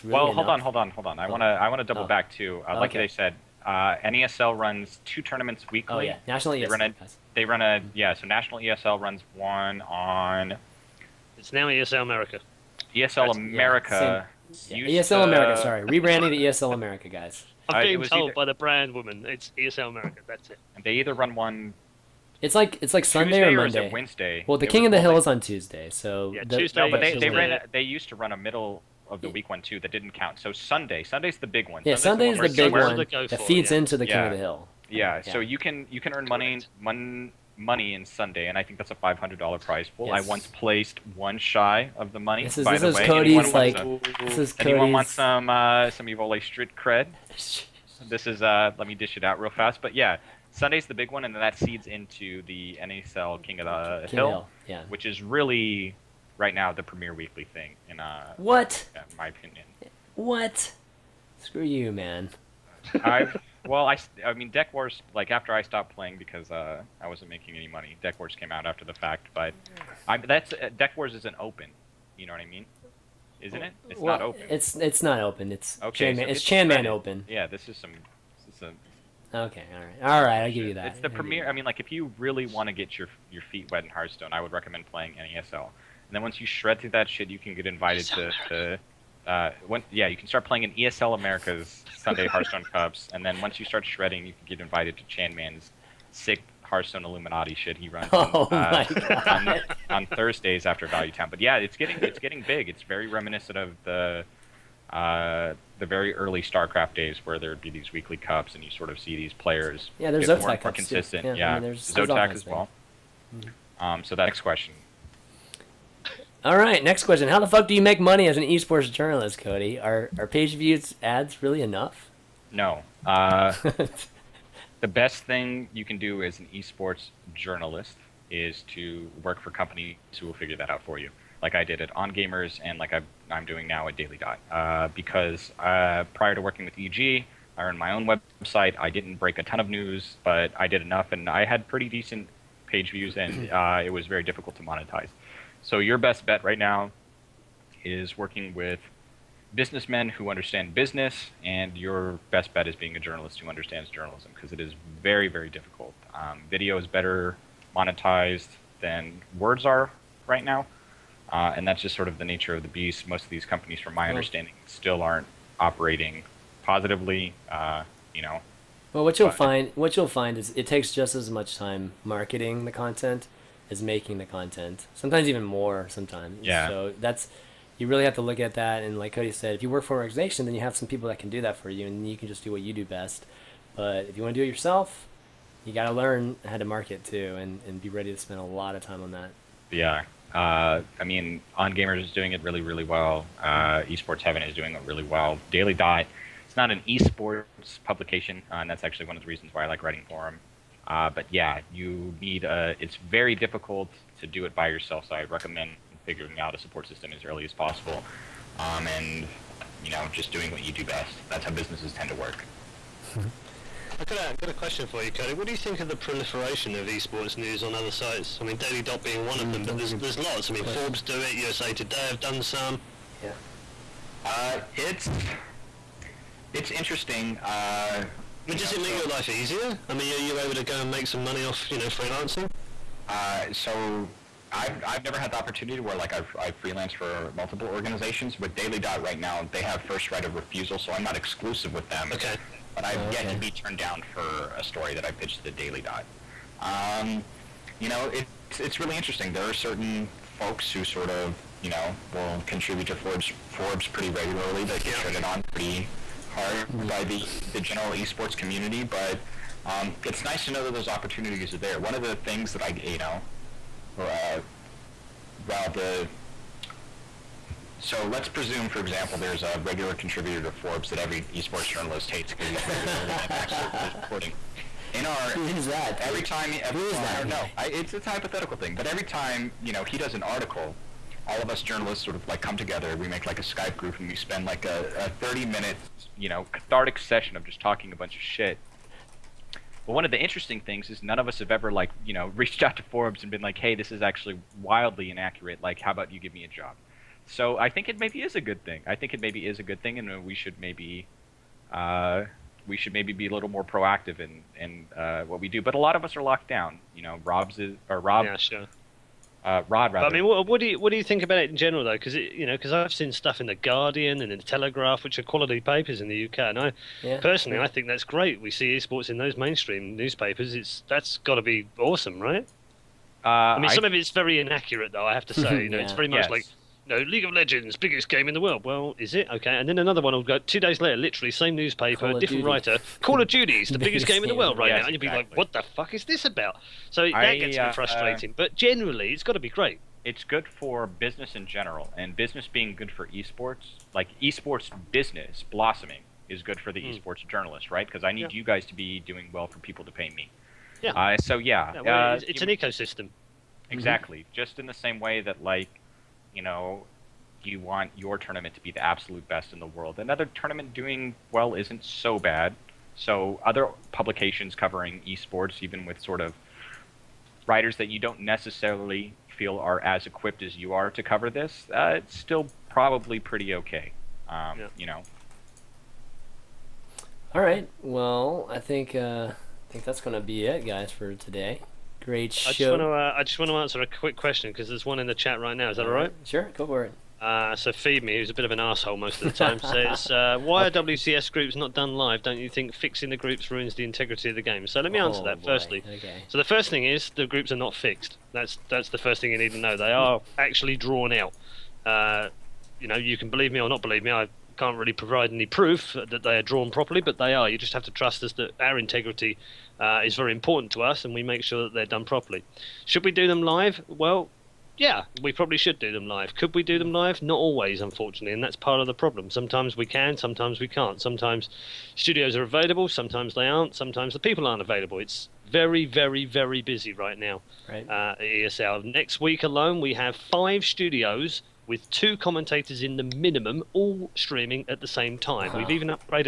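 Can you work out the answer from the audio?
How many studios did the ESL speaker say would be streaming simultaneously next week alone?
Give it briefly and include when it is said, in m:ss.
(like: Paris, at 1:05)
5, at 7:10.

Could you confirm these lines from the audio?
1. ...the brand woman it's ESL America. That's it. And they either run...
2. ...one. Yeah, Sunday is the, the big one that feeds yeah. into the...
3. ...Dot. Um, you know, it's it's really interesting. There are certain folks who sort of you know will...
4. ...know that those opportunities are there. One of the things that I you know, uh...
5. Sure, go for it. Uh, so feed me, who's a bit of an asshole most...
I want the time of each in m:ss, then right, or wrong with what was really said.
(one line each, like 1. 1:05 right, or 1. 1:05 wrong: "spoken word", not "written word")
1. 0:18 right
2. 0:31 right
3. 4:05 right
4. 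4:20 right
5. 6:26 right.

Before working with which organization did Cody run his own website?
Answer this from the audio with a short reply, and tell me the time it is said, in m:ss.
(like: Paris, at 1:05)
EG, at 2:16.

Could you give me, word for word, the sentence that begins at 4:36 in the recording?
Every time, every, who is well, that?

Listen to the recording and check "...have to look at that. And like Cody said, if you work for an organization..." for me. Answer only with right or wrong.
right.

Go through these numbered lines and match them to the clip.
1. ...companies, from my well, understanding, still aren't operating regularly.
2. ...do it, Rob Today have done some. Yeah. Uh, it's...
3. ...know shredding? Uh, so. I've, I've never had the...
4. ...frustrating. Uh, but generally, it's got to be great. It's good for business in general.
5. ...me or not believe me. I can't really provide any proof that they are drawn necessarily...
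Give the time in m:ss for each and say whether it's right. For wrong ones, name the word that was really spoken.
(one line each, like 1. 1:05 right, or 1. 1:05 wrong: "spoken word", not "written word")
1. 2:43 wrong: "positively", not "regularly"
2. 3:41 wrong: "USA", not "Rob"
3. 3:51 wrong: "freelancing", not "shredding"
4. 5:37 right
5. 6:43 wrong: "properly", not "necessarily".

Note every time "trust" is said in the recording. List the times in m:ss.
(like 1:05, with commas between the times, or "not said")
6:47.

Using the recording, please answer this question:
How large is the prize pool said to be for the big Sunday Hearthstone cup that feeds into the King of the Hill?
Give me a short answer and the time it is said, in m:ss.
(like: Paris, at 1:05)
$500, at 0:38.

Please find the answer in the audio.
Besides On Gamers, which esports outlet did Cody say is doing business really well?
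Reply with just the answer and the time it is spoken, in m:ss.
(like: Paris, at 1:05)
Esports Heaven, at 3:13.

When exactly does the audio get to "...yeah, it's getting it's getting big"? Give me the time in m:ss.
1:41.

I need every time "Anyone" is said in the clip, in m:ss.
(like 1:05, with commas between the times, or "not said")
0:44.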